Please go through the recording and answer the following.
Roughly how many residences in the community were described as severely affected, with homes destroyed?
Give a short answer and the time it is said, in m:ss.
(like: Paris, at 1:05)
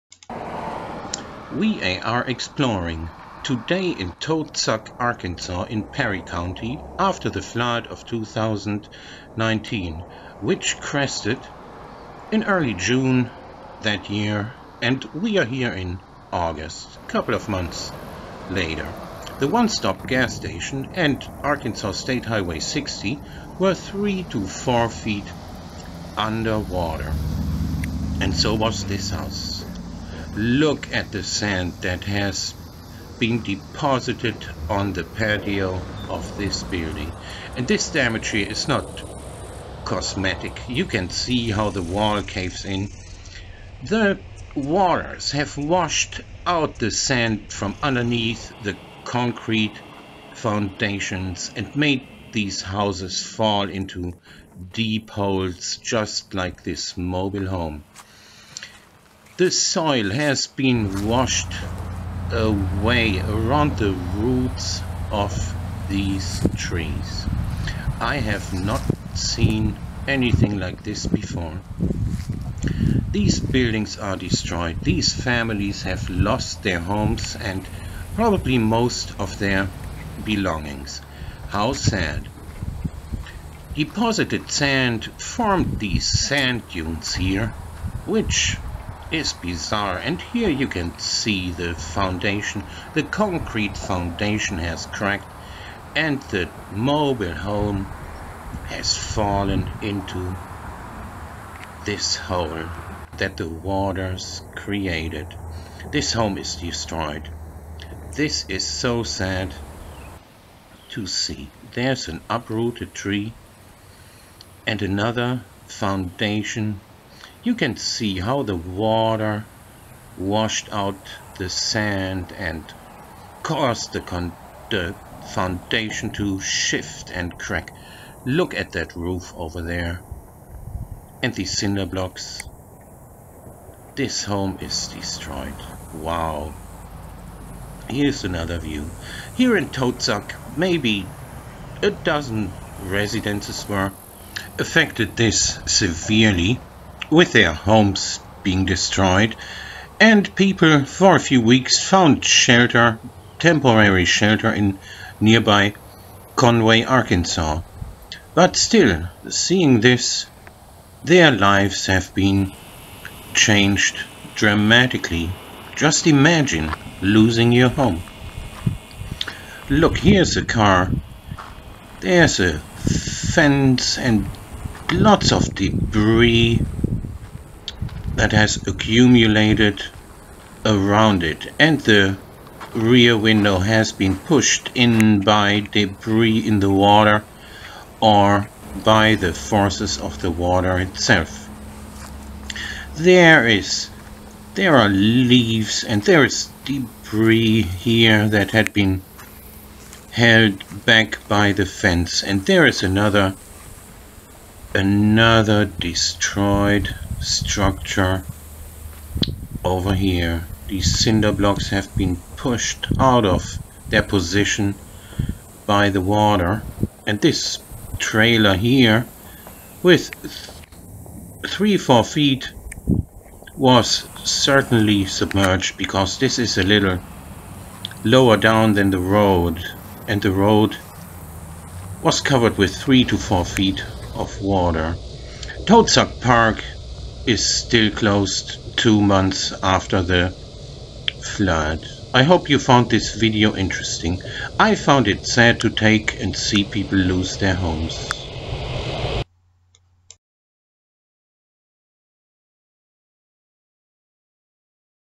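a dozen, at 2:20.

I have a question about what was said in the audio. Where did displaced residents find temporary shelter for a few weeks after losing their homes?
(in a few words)
Conway, Arkansas.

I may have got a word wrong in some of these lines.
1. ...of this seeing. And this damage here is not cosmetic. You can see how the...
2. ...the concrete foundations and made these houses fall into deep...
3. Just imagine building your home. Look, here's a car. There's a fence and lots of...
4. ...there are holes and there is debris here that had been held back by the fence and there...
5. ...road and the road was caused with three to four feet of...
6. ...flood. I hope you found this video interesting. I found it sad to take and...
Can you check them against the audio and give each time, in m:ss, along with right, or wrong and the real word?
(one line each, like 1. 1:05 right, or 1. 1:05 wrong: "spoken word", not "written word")
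1. 0:36 wrong: "building", not "seeing"
2. 0:48 right
3. 2:45 wrong: "losing", not "building"
4. 3:14 wrong: "leaves", not "holes"
5. 3:49 wrong: "covered", not "caused"
6. 4:01 right.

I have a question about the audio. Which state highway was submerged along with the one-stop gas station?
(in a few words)
Arkansas State Highway 60.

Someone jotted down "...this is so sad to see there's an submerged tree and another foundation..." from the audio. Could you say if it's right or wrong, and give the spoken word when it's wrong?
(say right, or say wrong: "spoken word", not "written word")
wrong: "uprooted", not "submerged".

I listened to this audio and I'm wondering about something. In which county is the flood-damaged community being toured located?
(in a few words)
Perry County.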